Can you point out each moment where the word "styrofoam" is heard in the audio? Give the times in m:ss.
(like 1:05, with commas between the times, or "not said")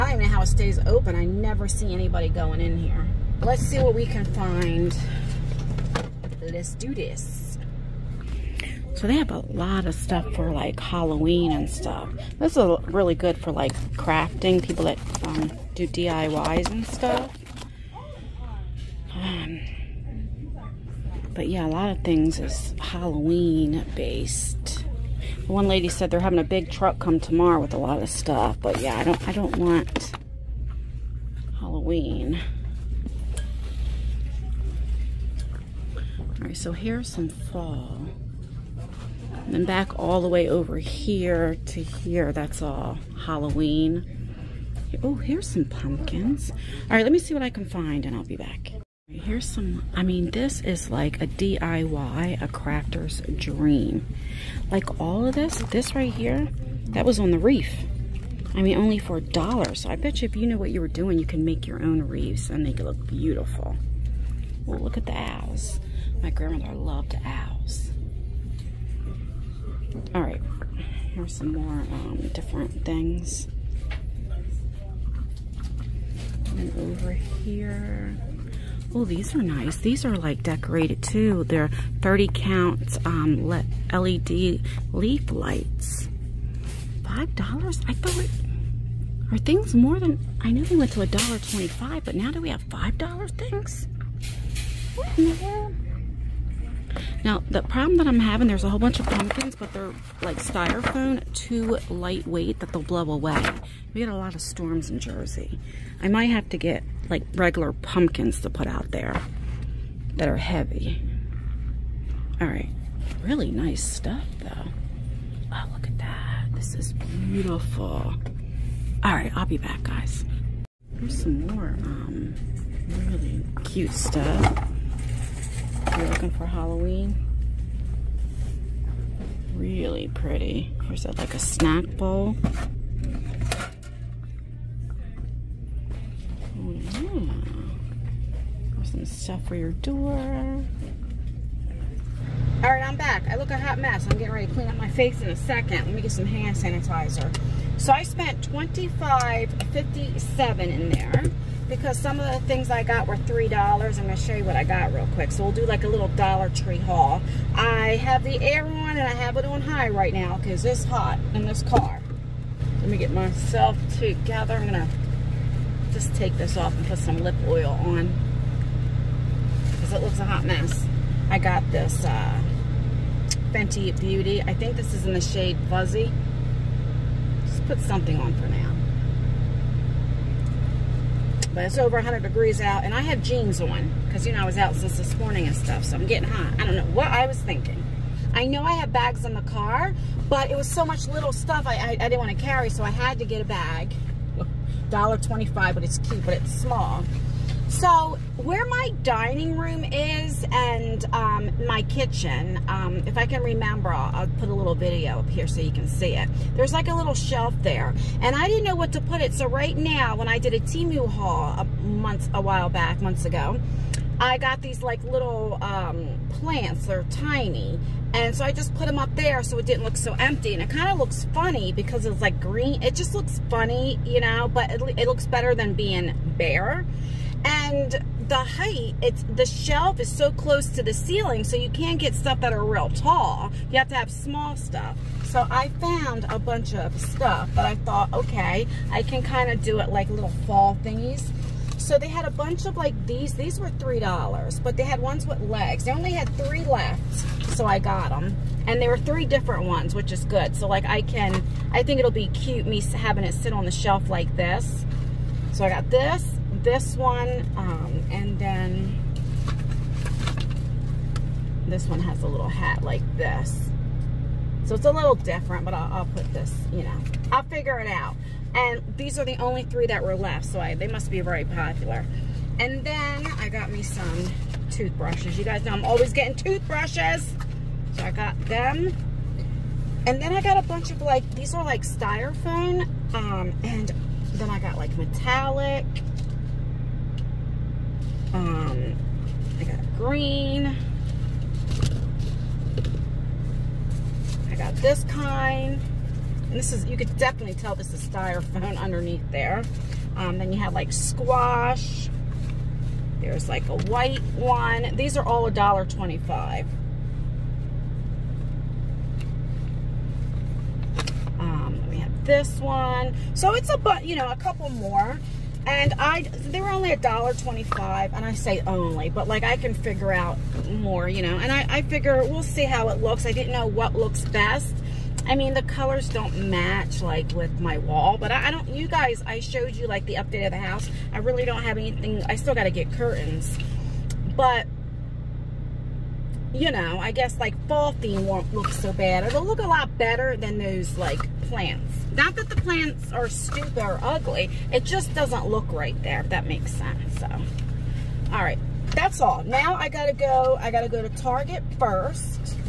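1:40, 4:41, 4:58.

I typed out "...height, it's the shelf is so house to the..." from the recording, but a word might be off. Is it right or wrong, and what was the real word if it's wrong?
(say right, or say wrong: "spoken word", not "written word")
wrong: "close", not "house".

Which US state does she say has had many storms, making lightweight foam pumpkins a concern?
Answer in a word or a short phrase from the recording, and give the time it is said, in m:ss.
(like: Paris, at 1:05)
Jersey, at 1:44.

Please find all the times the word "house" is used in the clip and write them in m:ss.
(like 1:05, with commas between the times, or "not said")
5:30.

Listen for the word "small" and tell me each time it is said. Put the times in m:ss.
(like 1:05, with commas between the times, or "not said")
3:16, 3:54.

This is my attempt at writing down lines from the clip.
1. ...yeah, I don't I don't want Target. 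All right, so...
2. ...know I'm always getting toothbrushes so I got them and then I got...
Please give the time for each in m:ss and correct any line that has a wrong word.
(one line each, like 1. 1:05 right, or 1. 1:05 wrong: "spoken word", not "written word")
1. 0:28 wrong: "Halloween", not "Target"
2. 4:35 right.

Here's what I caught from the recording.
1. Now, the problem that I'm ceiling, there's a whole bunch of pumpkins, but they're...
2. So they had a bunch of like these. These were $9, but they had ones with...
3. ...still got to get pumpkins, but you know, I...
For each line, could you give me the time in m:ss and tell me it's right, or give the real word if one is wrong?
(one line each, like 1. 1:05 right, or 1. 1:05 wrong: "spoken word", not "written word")
1. 1:37 wrong: "having", not "ceiling"
2. 4:01 wrong: "3", not "9"
3. 5:32 wrong: "curtains", not "pumpkins".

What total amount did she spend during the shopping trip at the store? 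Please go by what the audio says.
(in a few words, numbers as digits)
$25.57.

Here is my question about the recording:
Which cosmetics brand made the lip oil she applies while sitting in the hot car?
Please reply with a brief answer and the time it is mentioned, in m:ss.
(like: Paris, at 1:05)
Fenty Beauty, at 2:53.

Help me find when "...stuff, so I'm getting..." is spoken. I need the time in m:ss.
3:05.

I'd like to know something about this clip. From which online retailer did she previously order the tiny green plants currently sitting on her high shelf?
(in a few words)
Temu.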